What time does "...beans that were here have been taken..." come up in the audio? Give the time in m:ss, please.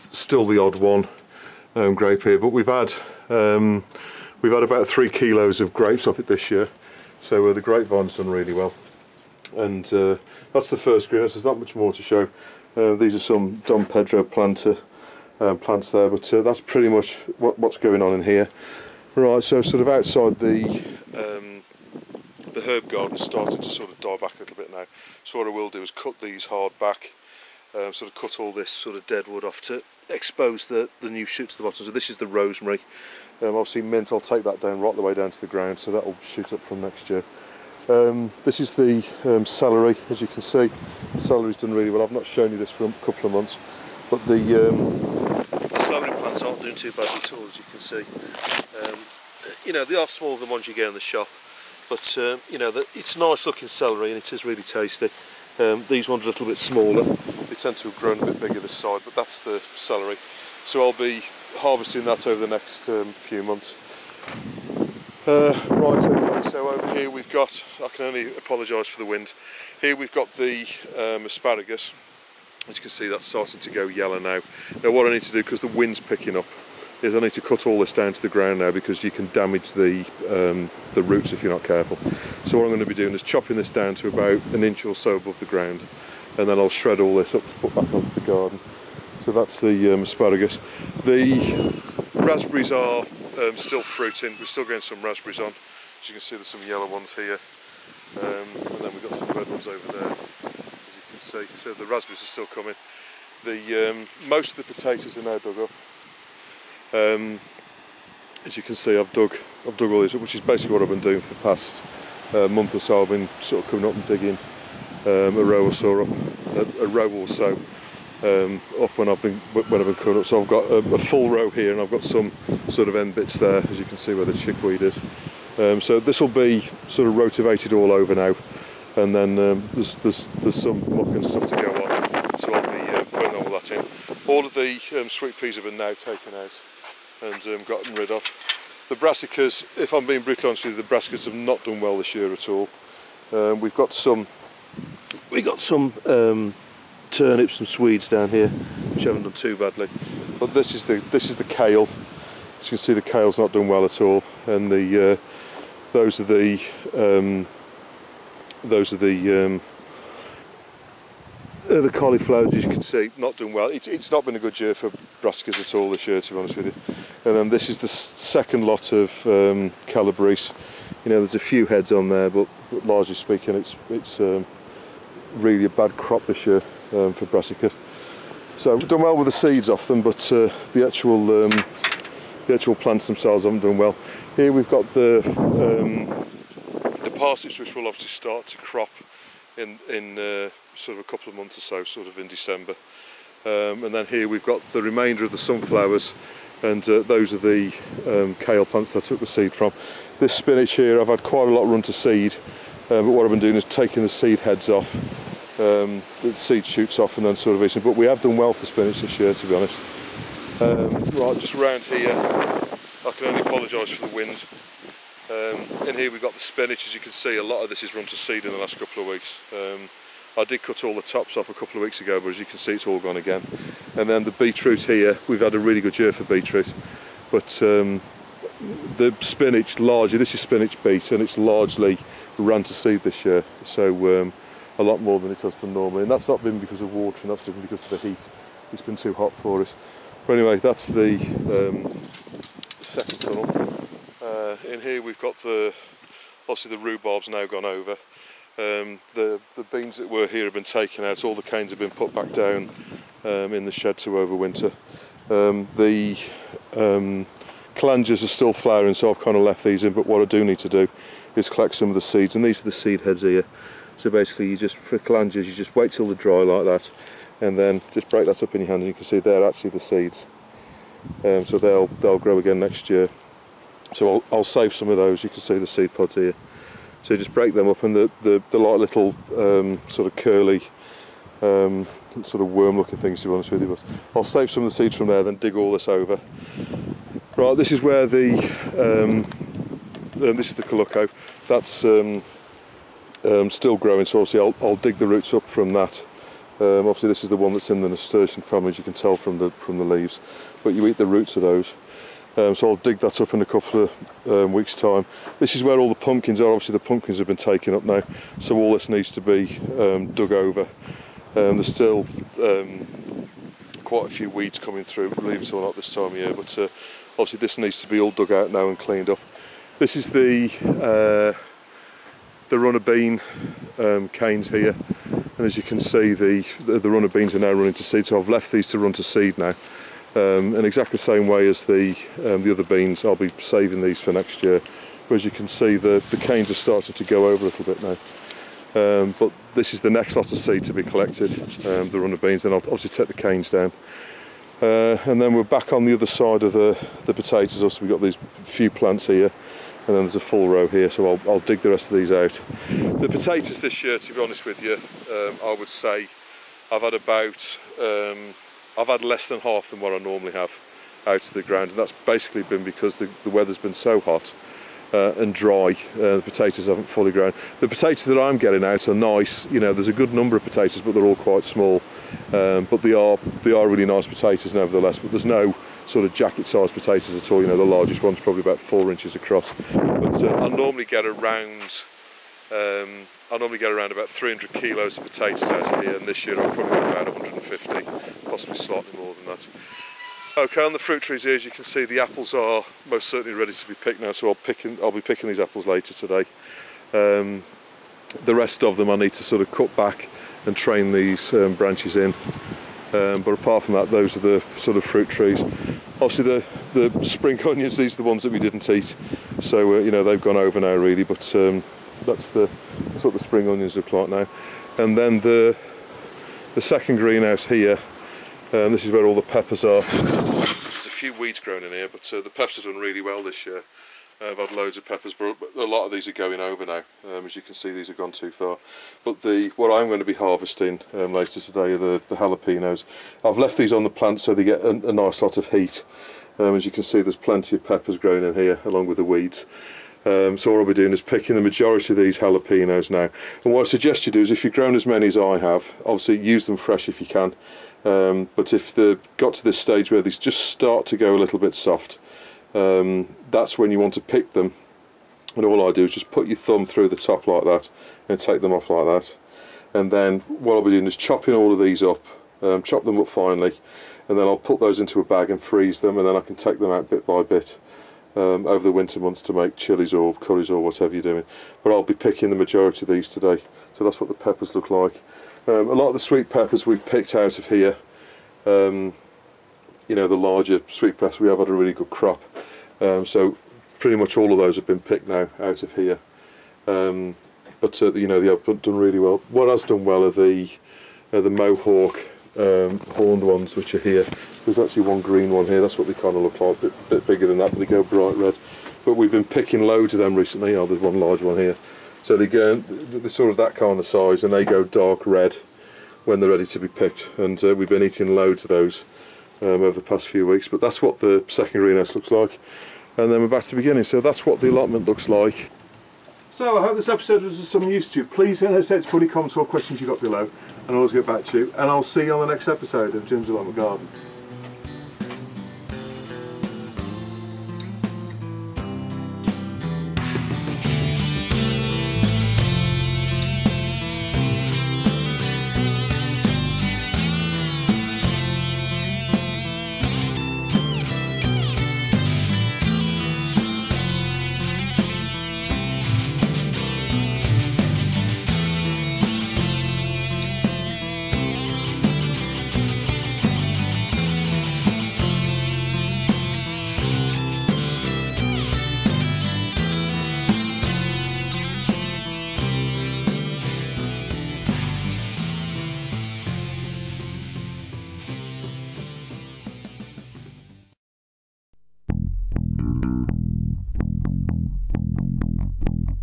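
4:09.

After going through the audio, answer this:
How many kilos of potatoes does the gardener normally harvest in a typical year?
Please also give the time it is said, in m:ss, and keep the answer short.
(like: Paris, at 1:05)
300 kilos, at 6:24.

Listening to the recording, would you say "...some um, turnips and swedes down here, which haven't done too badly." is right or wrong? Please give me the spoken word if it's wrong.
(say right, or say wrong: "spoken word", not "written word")
right.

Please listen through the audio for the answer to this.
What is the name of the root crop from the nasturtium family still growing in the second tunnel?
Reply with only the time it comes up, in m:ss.
4:50.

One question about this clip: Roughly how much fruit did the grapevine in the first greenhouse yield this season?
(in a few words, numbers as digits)
3 kilos.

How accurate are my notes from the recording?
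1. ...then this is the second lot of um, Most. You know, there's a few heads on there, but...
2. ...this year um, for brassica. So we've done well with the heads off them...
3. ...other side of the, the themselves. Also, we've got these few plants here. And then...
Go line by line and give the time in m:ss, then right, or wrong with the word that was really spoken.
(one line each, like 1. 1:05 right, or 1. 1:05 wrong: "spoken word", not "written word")
1. 2:47 wrong: "Calabrese", not "Most"
2. 2:56 wrong: "seeds", not "heads"
3. 5:45 wrong: "potatoes", not "themselves".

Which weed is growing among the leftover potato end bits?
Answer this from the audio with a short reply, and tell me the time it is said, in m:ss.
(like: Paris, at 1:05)
Chickweed, at 2:04.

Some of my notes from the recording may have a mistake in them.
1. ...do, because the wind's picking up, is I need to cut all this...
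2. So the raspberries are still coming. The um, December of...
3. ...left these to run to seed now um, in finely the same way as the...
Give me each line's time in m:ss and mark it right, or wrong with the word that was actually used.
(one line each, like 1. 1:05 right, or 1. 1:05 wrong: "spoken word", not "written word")
1. 1:15 right
2. 1:41 wrong: "Most", not "December"
3. 5:28 wrong: "exactly", not "finely".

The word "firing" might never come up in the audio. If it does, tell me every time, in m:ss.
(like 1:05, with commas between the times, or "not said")
not said.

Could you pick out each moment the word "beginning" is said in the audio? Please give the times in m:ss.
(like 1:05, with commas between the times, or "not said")
8:33.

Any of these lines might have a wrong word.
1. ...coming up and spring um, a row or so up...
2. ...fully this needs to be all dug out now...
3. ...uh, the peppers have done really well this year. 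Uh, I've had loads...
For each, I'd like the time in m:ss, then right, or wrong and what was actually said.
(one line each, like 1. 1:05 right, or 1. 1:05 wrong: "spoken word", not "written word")
1. 1:53 wrong: "digging", not "spring"
2. 5:17 wrong: "obviously", not "fully"
3. 7:02 right.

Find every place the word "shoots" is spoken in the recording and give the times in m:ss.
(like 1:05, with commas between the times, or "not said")
0:31, 0:36, 3:26.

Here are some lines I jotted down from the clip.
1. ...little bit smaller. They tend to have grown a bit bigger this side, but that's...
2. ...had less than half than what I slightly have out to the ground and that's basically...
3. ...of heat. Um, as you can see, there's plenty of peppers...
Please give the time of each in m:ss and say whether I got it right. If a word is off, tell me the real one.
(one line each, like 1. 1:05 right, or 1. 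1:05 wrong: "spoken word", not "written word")
1. 0:56 right
2. 5:58 wrong: "normally", not "slightly"
3. 7:15 right.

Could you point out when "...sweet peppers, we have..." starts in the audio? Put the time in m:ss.
8:00.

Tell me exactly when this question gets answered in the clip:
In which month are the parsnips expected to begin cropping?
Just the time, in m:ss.
3:12.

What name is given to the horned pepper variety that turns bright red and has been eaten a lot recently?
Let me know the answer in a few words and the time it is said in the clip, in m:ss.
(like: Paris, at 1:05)
Mohawk, at 8:11.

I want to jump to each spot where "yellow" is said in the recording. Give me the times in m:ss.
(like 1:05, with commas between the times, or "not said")
1:13, 1:36.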